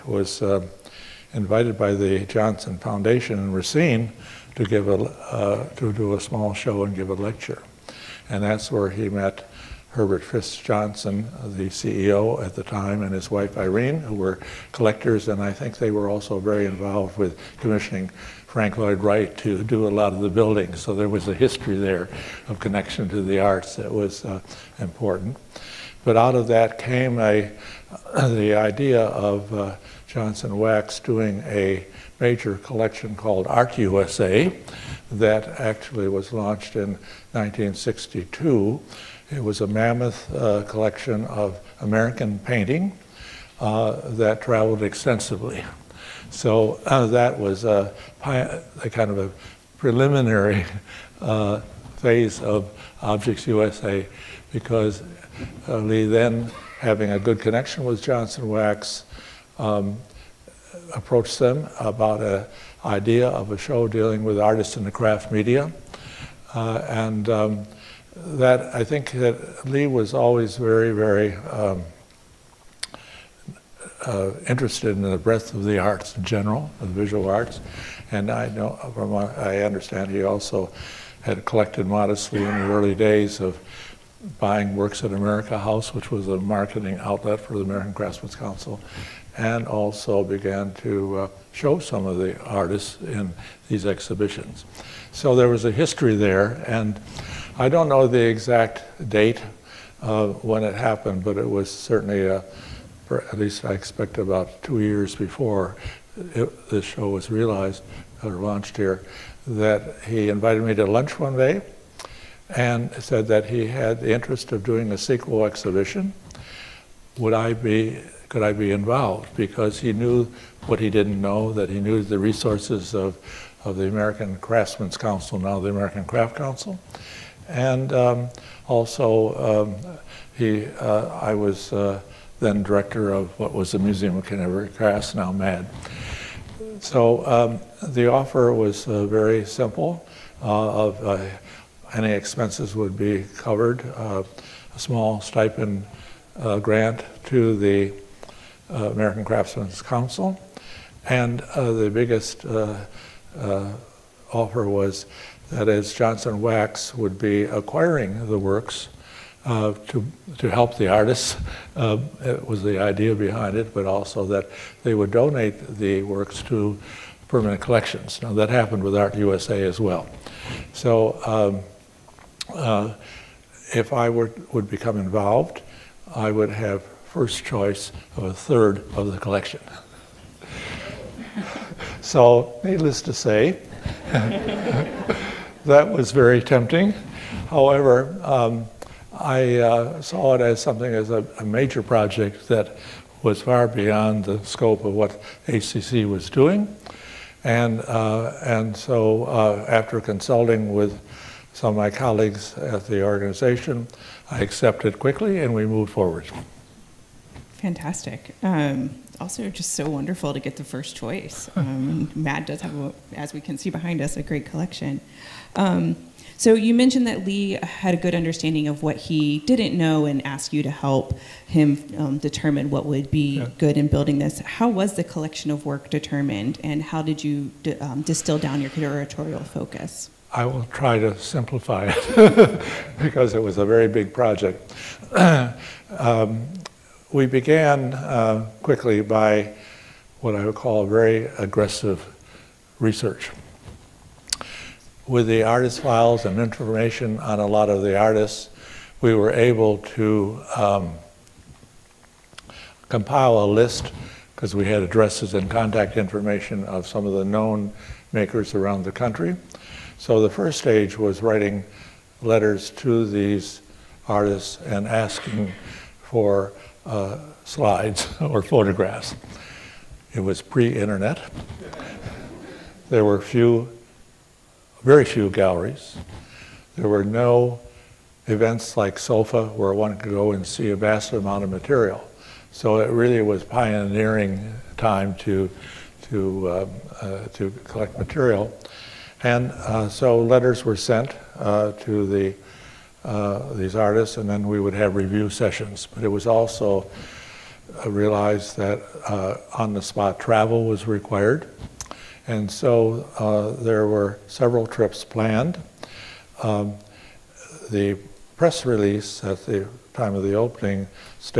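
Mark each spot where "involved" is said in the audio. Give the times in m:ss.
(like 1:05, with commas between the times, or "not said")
0:16, 1:58, 2:54.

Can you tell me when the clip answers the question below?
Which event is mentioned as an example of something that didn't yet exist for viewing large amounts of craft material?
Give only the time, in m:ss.
4:38.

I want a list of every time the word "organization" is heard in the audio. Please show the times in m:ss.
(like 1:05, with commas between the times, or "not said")
3:23.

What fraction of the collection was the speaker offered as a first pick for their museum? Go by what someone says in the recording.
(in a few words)
A third.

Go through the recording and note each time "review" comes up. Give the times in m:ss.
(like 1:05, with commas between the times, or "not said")
4:54.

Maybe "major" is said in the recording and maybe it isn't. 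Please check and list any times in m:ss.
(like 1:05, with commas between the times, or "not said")
0:32, 3:11.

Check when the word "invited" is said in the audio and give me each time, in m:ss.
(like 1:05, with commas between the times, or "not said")
0:01, 1:50.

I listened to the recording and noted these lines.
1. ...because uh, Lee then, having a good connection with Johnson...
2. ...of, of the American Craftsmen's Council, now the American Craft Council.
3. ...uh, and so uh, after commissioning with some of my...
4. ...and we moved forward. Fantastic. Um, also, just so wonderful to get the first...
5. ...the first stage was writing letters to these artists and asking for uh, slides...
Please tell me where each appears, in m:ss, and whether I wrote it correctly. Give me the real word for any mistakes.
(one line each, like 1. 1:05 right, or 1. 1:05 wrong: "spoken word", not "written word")
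1. 0:54 right
2. 2:02 right
3. 3:17 wrong: "consulting", not "commissioning"
4. 3:25 right
5. 4:20 right.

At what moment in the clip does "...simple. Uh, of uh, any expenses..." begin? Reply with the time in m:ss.
2:19.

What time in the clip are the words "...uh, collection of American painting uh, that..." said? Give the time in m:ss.
0:40.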